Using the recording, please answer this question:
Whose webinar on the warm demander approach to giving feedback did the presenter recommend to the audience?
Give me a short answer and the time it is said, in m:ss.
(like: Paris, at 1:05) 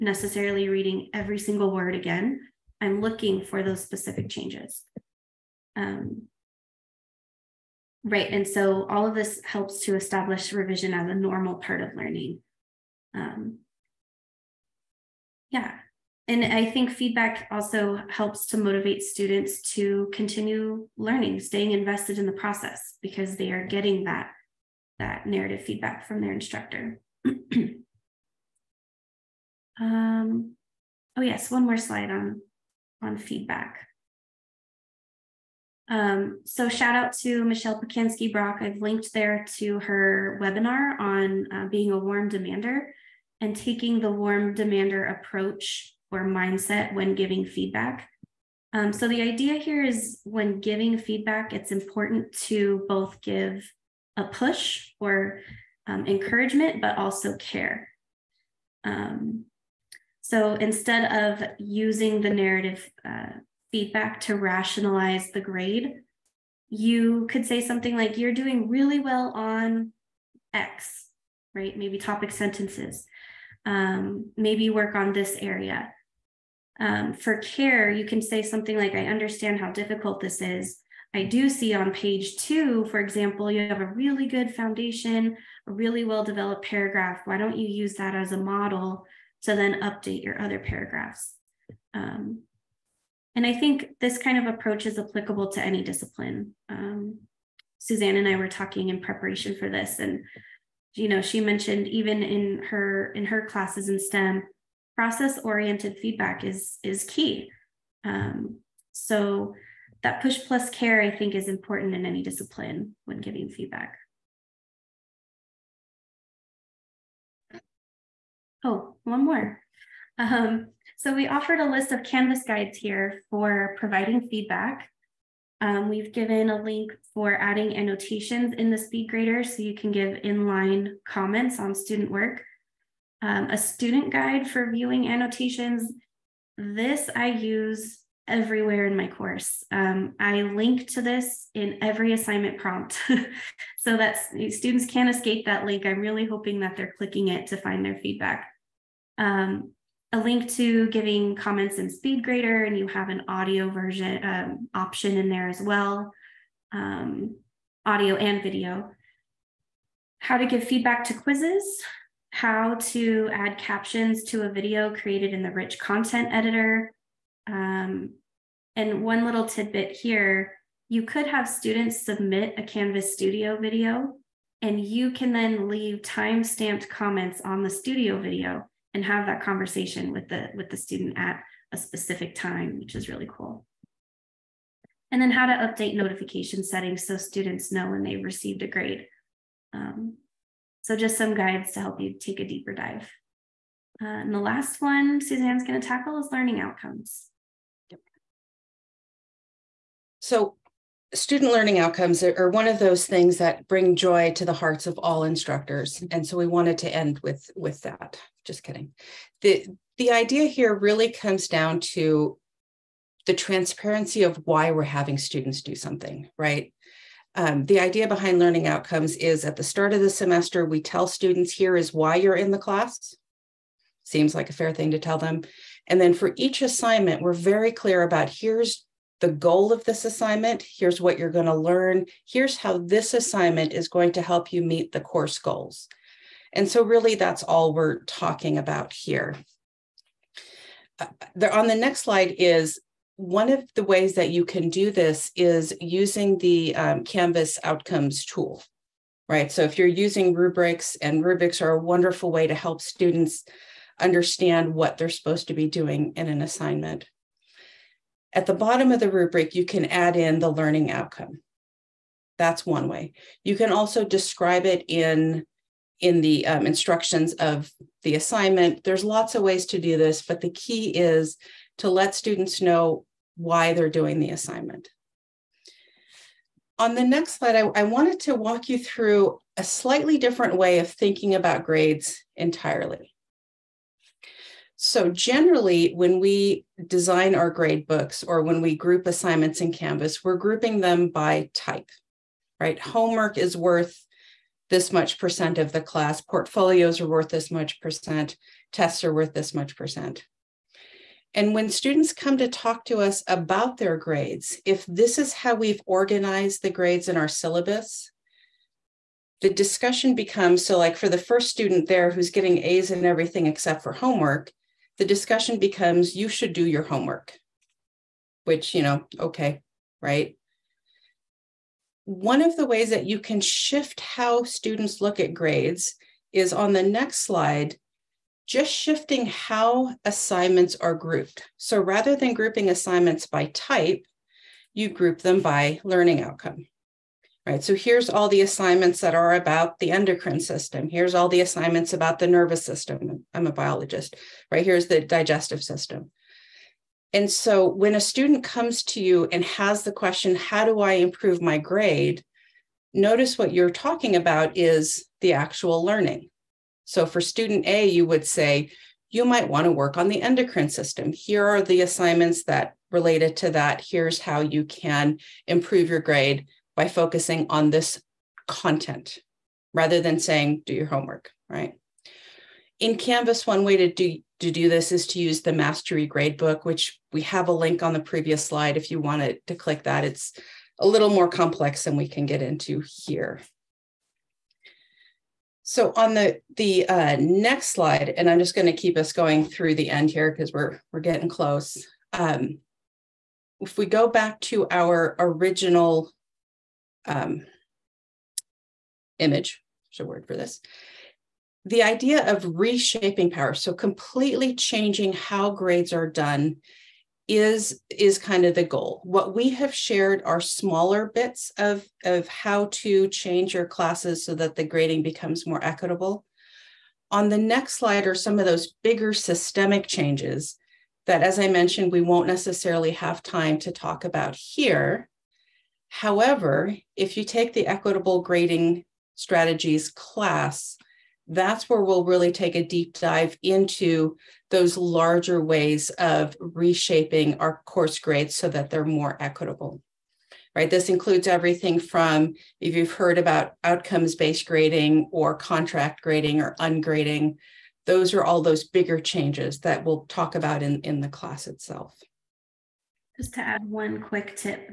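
Michelle Pacansky-Brock, at 0:37.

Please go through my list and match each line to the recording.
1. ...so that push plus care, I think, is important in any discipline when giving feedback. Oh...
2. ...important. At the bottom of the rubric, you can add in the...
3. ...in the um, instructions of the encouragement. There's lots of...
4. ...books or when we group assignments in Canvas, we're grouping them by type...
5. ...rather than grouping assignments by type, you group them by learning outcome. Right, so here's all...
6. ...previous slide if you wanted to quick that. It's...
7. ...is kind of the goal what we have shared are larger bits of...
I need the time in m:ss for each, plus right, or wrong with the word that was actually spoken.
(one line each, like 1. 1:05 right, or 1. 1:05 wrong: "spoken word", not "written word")
1. 1:48 right
2. 4:16 wrong: "assignment", not "important"
3. 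4:25 wrong: "assignment", not "encouragement"
4. 4:47 right
5. 5:31 right
6. 6:17 wrong: "click", not "quick"
7. 6:47 wrong: "smaller", not "larger".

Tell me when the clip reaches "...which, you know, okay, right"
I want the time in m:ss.
5:18.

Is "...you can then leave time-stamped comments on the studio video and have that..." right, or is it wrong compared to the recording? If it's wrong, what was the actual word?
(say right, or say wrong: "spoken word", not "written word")
right.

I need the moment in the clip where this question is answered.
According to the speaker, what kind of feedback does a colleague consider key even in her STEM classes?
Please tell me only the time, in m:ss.
1:44.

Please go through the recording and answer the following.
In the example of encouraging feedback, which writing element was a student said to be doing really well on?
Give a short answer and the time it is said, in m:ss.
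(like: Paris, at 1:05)
topic sentences, at 1:11.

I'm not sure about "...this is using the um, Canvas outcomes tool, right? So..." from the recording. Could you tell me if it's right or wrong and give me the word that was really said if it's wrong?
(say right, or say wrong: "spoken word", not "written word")
right.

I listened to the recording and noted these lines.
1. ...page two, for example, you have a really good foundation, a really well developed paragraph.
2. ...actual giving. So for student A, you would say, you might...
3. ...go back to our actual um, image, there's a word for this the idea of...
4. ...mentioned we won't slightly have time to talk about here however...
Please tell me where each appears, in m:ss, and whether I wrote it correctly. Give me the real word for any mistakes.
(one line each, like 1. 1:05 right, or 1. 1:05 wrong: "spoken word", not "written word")
1. 1:21 right
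2. 5:55 wrong: "learning", not "giving"
3. 6:33 wrong: "original", not "actual"
4. 7:01 wrong: "necessarily", not "slightly".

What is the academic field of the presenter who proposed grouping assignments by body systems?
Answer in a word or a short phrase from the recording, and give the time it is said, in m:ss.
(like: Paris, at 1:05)
biologist, at 5:43.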